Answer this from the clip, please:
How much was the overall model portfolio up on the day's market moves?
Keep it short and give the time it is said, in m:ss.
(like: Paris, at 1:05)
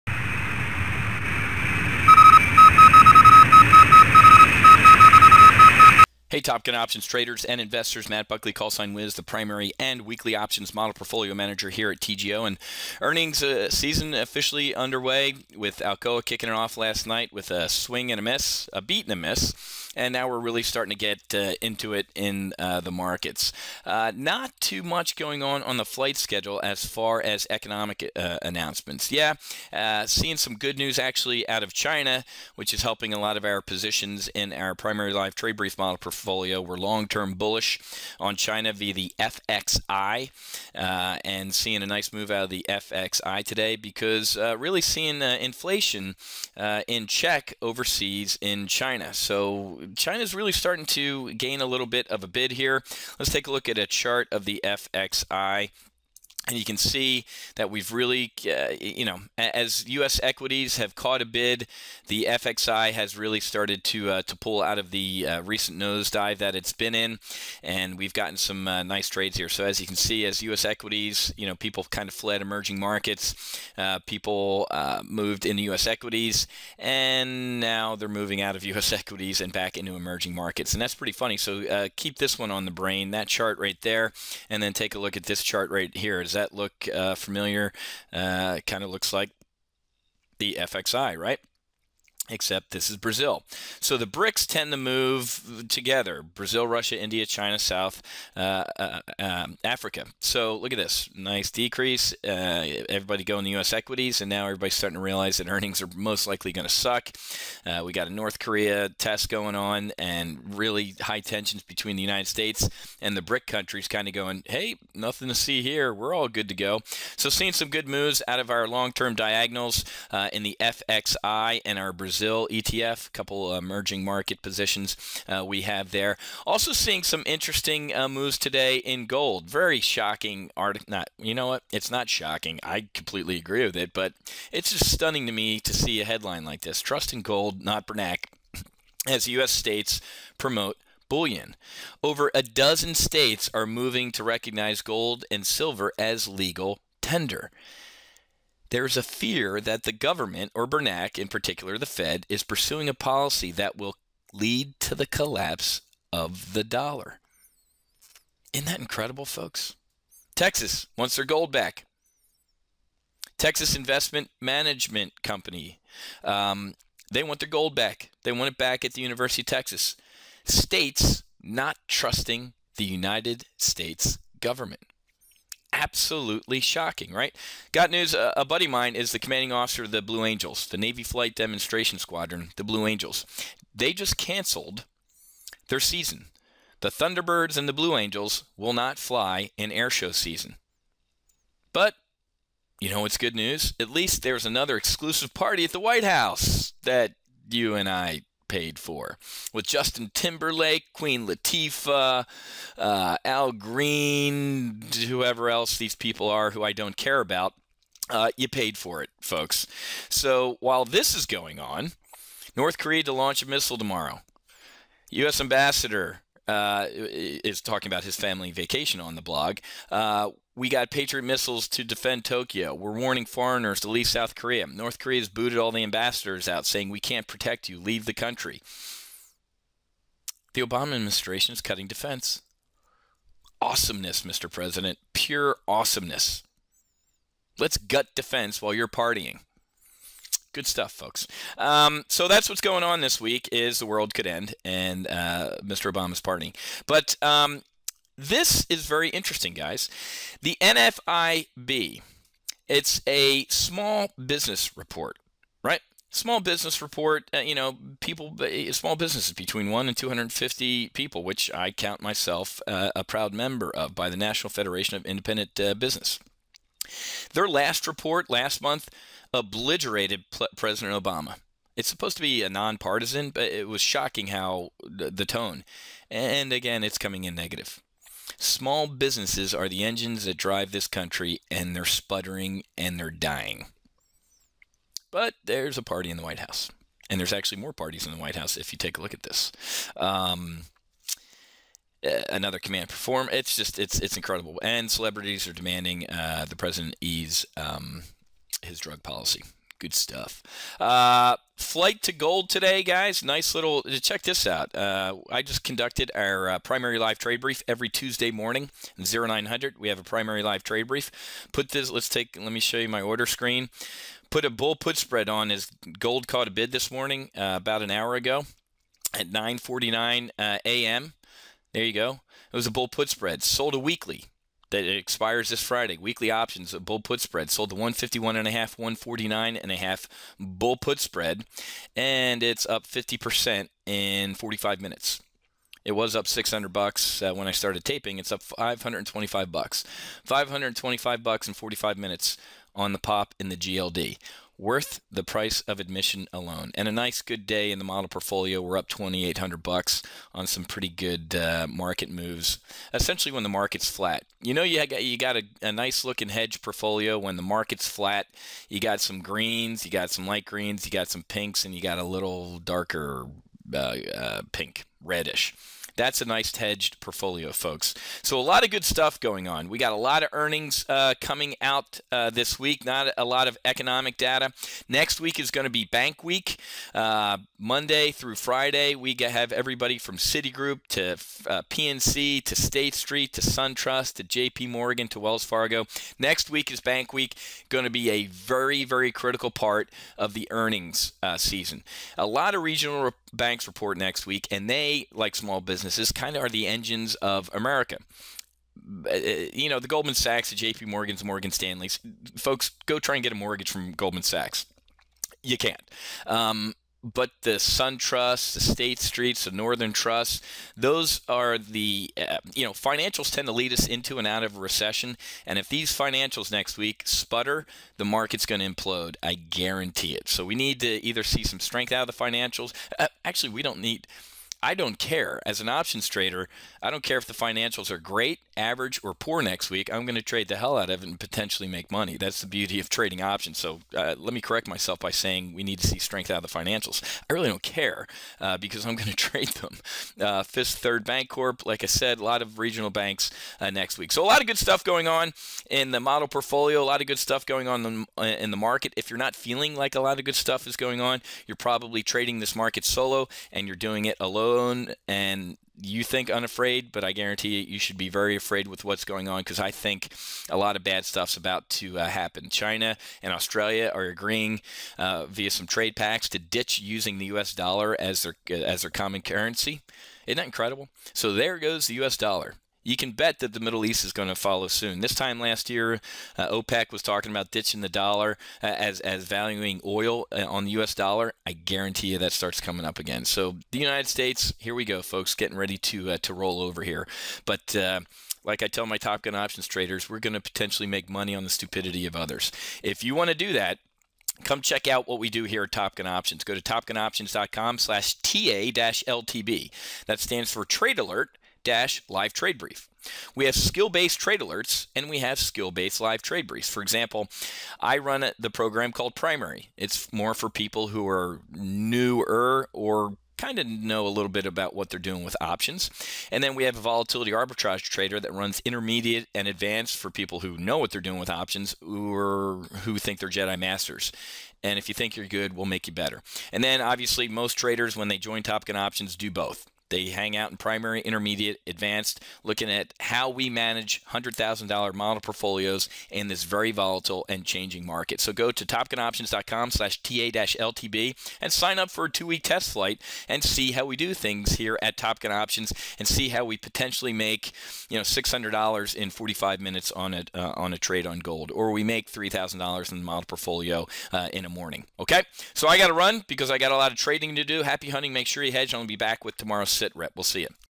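$2,800, at 5:48.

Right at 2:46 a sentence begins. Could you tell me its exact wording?
Um, they want their gold back.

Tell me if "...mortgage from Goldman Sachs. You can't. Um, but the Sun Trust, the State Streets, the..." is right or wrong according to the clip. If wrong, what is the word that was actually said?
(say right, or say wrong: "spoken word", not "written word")
right.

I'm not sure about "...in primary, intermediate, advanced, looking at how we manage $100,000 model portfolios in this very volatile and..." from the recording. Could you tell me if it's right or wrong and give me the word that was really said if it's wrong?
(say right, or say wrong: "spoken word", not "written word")
right.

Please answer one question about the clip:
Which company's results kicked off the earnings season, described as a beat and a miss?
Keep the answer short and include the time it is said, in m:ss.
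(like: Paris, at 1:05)
Alcoa, at 0:15.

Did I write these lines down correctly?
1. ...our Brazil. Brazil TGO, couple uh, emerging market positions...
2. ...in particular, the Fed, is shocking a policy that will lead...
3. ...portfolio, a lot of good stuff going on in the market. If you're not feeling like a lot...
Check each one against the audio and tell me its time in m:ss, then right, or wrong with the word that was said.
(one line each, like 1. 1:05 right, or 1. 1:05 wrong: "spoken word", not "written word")
1. 2:01 wrong: "ETF", not "TGO"
2. 2:31 wrong: "pursuing", not "shocking"
3. 7:26 right.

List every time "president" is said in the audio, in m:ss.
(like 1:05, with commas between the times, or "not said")
3:54, 4:30, 4:56.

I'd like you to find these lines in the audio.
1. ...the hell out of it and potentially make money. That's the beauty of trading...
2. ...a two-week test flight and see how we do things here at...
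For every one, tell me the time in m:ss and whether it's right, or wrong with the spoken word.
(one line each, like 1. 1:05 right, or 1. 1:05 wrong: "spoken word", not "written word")
1. 7:10 right
2. 9:02 right.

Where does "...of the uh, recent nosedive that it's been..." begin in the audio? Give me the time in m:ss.
1:04.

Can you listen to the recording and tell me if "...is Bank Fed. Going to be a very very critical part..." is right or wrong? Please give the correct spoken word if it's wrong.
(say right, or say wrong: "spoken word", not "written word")
wrong: "Week", not "Fed".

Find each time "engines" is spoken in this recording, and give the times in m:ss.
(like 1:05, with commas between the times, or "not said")
4:39, 6:36.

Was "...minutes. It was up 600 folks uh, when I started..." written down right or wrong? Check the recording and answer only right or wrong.
wrong.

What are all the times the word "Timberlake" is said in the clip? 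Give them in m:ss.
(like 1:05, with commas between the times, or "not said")
3:20.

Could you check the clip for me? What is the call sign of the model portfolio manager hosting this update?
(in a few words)
Wiz.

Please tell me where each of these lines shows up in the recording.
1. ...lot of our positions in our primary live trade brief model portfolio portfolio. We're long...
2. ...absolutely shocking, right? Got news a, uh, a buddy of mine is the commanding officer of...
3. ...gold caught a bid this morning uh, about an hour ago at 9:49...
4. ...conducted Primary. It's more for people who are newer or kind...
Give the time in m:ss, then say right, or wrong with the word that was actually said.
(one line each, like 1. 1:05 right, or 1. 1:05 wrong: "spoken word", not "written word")
1. 0:33 right
2. 2:55 right
3. 5:15 right
4. 8:28 wrong: "called", not "conducted".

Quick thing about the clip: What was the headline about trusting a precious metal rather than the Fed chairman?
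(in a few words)
Trust in gold, not Bernanke.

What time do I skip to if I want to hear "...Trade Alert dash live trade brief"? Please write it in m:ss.
8:20.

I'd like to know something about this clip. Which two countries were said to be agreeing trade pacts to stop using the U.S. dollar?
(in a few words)
China and Australia.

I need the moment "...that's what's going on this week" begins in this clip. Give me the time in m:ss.
4:02.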